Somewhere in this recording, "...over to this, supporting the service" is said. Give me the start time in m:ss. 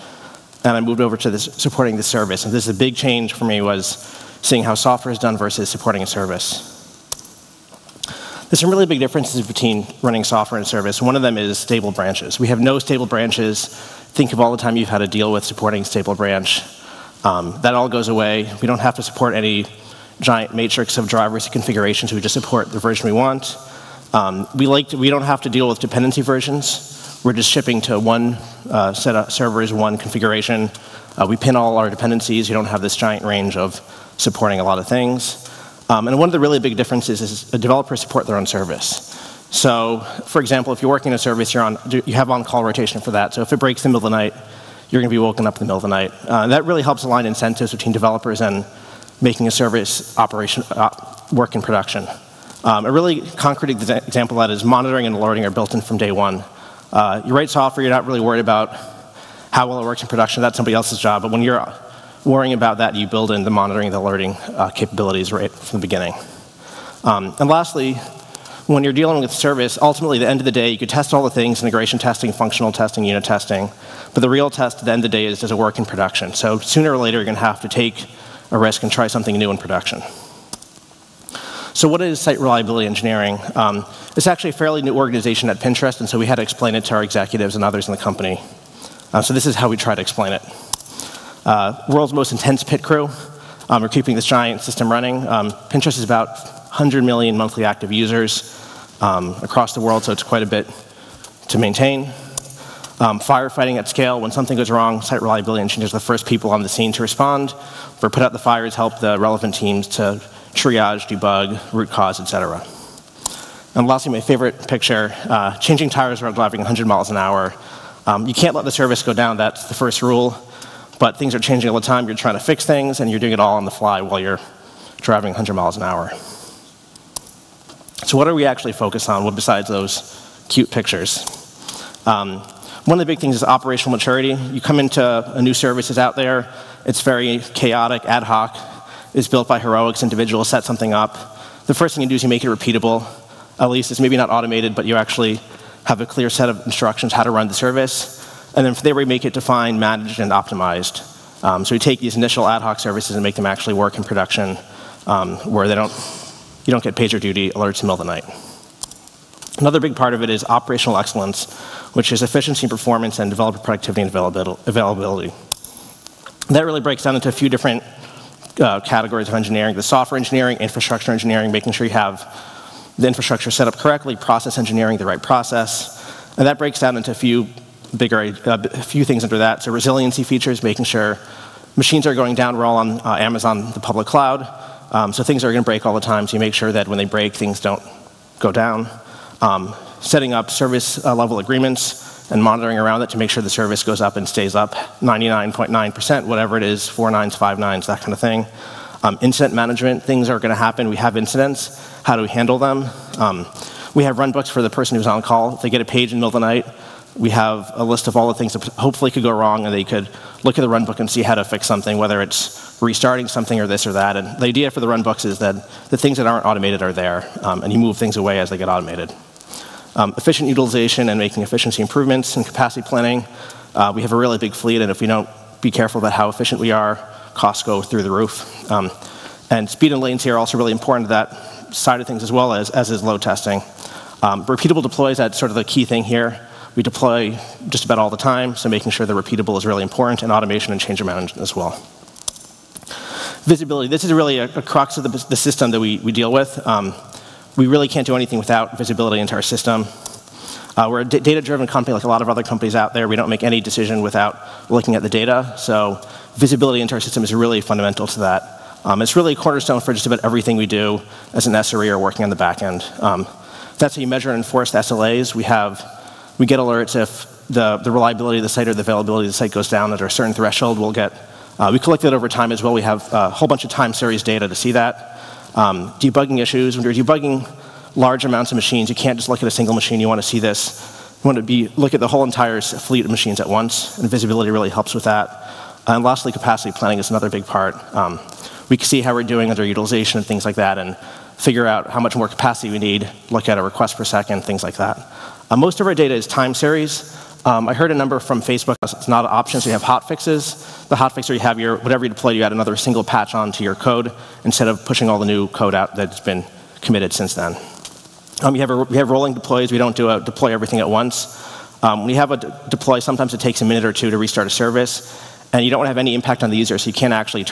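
0:01.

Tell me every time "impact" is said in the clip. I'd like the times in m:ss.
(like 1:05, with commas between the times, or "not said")
5:16.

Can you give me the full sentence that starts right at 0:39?
So, for example, if you're working a service, you're on, you have on-call rotation for that.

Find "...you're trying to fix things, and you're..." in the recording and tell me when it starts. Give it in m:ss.
2:02.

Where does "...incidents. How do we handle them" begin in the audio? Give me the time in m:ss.
3:21.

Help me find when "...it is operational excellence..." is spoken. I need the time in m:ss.
2:40.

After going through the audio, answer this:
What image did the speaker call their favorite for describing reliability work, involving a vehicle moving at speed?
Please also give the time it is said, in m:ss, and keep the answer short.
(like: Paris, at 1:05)
Changing tires while driving, at 1:55.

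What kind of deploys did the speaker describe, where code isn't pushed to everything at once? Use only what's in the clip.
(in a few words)
Rolling deploys.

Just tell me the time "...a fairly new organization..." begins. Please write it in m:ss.
1:24.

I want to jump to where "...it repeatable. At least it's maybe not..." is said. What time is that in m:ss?
2:22.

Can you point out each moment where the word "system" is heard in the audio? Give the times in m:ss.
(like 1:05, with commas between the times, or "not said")
1:34, 4:05, 4:09, 4:17.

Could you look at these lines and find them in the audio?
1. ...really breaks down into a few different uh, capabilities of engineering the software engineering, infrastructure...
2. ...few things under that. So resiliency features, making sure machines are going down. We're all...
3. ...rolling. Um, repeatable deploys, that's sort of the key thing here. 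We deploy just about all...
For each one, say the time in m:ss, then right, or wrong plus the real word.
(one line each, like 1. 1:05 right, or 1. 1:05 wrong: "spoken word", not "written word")
1. 2:46 wrong: "categories", not "capabilities"
2. 2:58 right
3. 3:53 wrong: "testing", not "rolling".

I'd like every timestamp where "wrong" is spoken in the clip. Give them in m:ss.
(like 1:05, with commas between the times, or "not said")
1:44, 3:29.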